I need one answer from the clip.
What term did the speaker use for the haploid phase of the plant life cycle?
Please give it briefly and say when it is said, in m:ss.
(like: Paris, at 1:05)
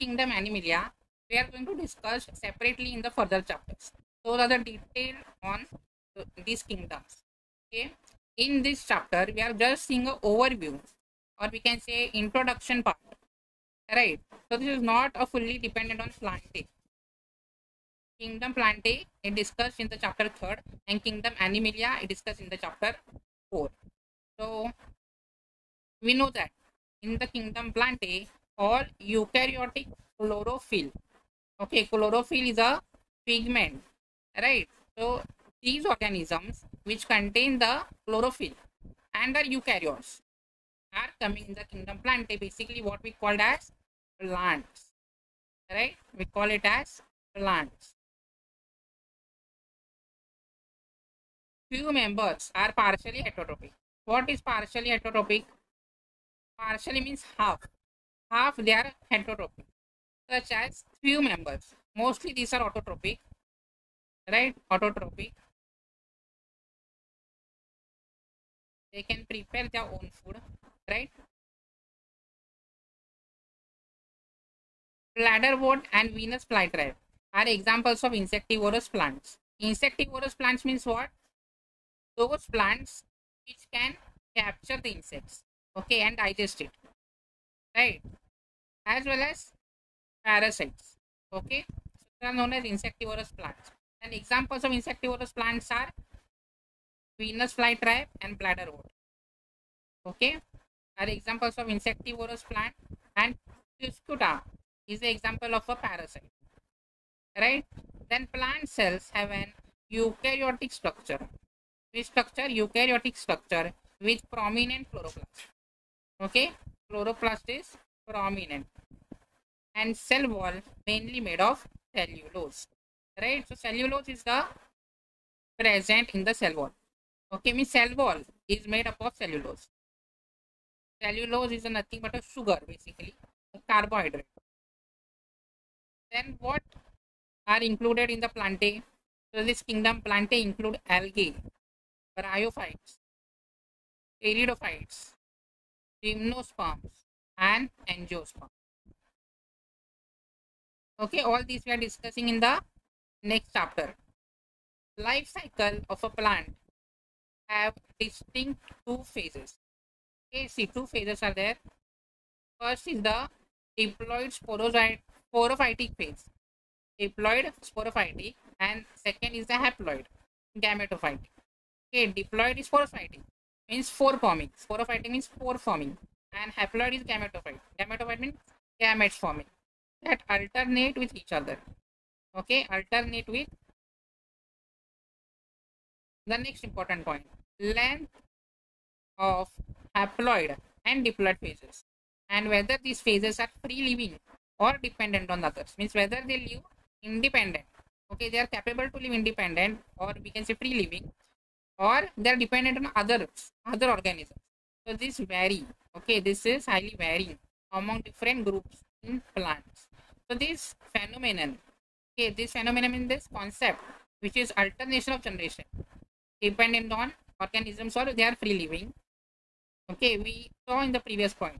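gametophytic, at 2:50.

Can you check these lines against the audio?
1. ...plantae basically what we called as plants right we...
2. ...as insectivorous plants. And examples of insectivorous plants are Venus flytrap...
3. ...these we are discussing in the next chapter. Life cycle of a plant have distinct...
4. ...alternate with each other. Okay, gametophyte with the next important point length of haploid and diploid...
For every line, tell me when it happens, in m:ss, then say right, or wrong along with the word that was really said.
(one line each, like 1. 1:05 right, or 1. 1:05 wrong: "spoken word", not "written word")
1. 0:42 right
2. 1:32 right
3. 2:31 right
4. 3:00 wrong: "alternate", not "gametophyte".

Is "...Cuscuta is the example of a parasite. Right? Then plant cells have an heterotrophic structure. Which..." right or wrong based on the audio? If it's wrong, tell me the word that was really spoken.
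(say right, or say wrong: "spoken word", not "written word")
wrong: "eukaryotic", not "heterotrophic".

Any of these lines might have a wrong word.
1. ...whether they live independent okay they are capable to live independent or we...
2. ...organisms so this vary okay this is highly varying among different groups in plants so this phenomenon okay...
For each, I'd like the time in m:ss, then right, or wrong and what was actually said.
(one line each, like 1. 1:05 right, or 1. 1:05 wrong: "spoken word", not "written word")
1. 3:15 right
2. 3:23 right.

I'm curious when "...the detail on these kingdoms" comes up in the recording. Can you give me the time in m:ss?
0:04.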